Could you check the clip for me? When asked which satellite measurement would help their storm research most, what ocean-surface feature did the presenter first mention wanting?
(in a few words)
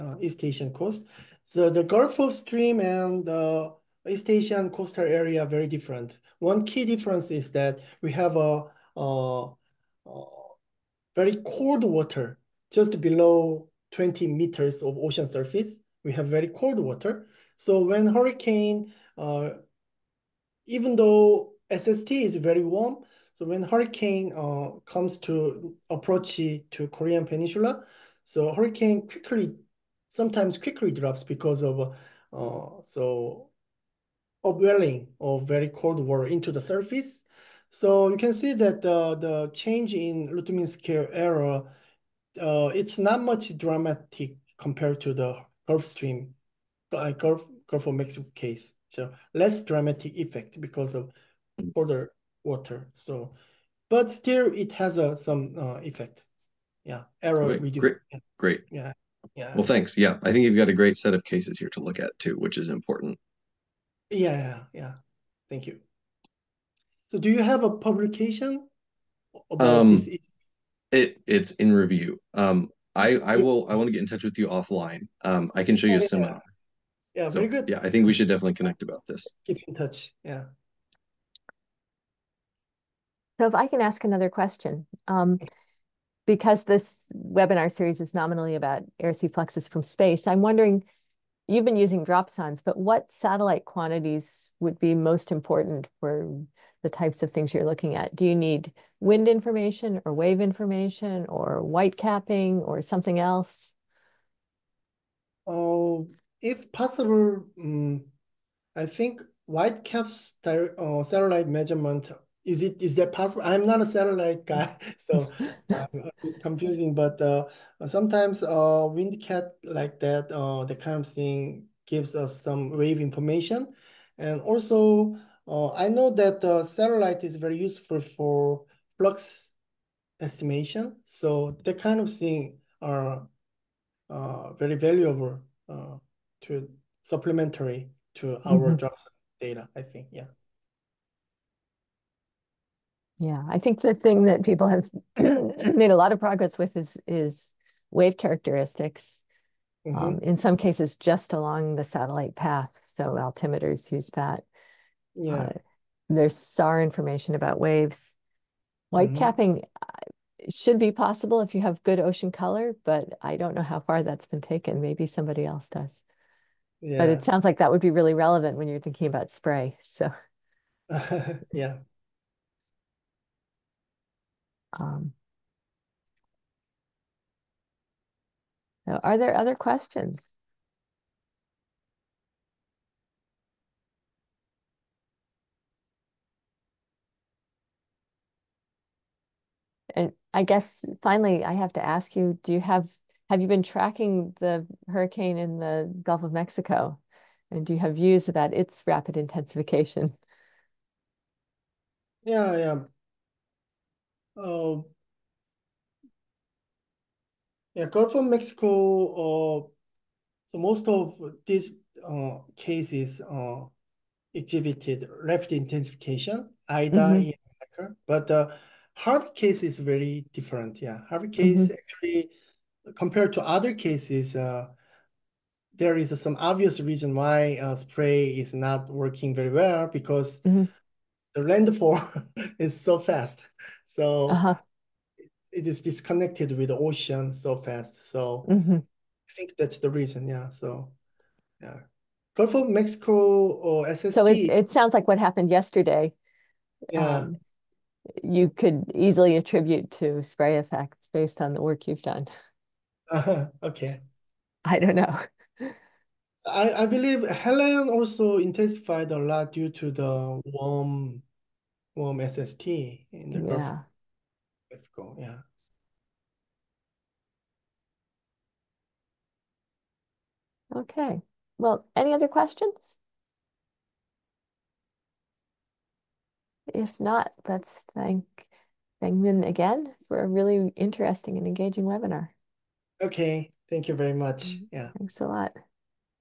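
White caps.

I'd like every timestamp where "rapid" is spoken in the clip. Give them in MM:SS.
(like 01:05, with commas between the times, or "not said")
03:18, 03:35.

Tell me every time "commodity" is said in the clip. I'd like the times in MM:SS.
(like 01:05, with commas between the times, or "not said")
not said.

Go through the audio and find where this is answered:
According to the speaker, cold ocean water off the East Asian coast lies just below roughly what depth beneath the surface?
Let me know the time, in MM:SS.
00:13.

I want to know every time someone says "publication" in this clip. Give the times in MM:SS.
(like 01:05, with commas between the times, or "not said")
01:07.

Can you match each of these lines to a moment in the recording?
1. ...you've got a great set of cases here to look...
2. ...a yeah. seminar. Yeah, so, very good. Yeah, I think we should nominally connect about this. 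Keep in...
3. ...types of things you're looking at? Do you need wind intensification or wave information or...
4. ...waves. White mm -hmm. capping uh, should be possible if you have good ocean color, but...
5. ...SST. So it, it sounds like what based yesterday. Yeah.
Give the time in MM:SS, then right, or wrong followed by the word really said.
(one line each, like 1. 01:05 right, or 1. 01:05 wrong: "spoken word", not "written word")
1. 01:00 right
2. 01:15 wrong: "definitely", not "nominally"
3. 01:36 wrong: "information", not "intensification"
4. 02:37 right
5. 04:03 wrong: "happened", not "based".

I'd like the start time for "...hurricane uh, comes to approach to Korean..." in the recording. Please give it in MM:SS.
00:23.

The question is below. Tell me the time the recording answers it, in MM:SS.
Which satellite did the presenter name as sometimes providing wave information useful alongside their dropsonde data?
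01:58.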